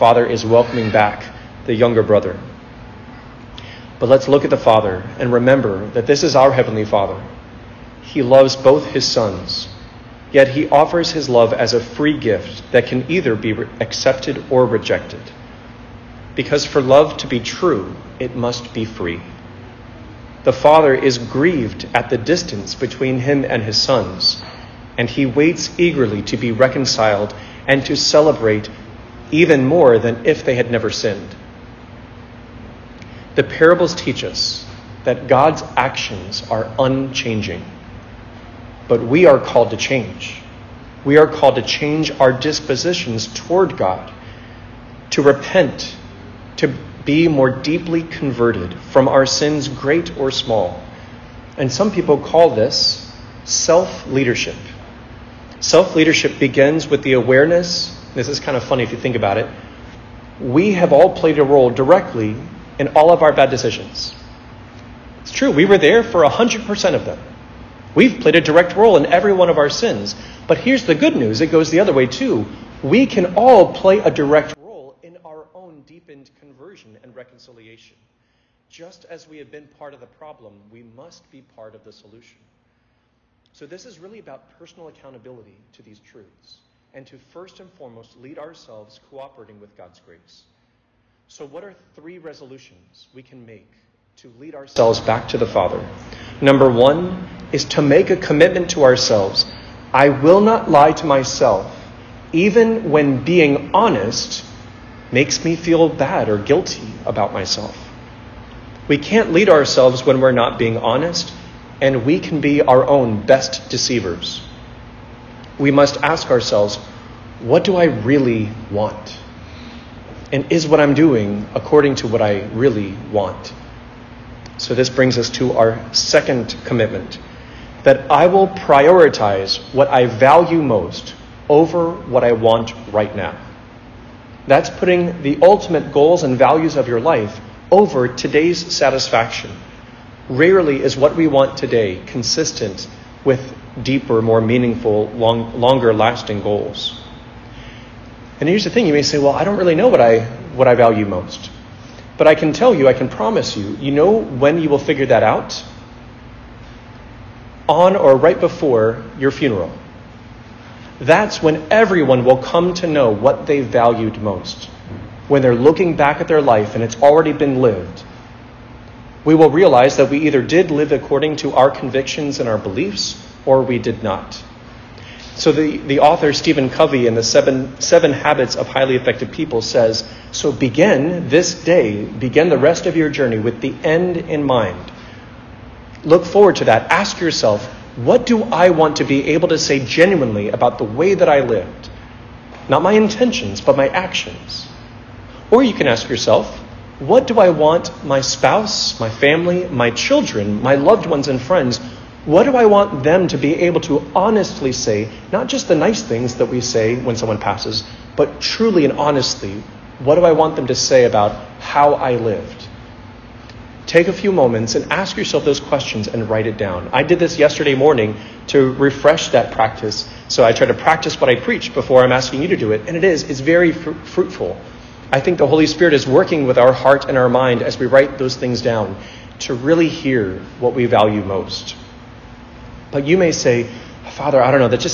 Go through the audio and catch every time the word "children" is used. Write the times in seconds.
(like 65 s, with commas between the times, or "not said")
199 s.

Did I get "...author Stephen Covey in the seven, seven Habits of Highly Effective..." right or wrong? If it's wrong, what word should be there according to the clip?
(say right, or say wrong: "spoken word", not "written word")
right.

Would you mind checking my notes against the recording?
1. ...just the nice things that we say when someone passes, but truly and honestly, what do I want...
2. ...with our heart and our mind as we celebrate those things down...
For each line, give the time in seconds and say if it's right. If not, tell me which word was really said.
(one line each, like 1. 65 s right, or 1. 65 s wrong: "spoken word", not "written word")
1. 205 s right
2. 226 s wrong: "write", not "celebrate".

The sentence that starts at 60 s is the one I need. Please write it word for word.
We have all played a role directly in all of our bad decisions.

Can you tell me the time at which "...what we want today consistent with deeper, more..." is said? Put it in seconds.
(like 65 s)
140 s.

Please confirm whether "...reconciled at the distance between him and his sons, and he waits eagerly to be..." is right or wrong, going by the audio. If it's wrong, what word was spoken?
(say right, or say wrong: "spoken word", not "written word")
wrong: "grieved", not "reconciled".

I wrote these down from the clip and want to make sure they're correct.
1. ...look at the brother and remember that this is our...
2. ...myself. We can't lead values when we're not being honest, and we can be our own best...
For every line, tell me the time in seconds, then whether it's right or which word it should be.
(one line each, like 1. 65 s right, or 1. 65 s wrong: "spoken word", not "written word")
1. 4 s wrong: "father", not "brother"
2. 107 s wrong: "ourselves", not "values".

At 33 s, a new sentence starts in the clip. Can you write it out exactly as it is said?
The parables teach us that God's actions are unchanging.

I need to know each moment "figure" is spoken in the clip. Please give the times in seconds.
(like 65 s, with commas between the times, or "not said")
154 s.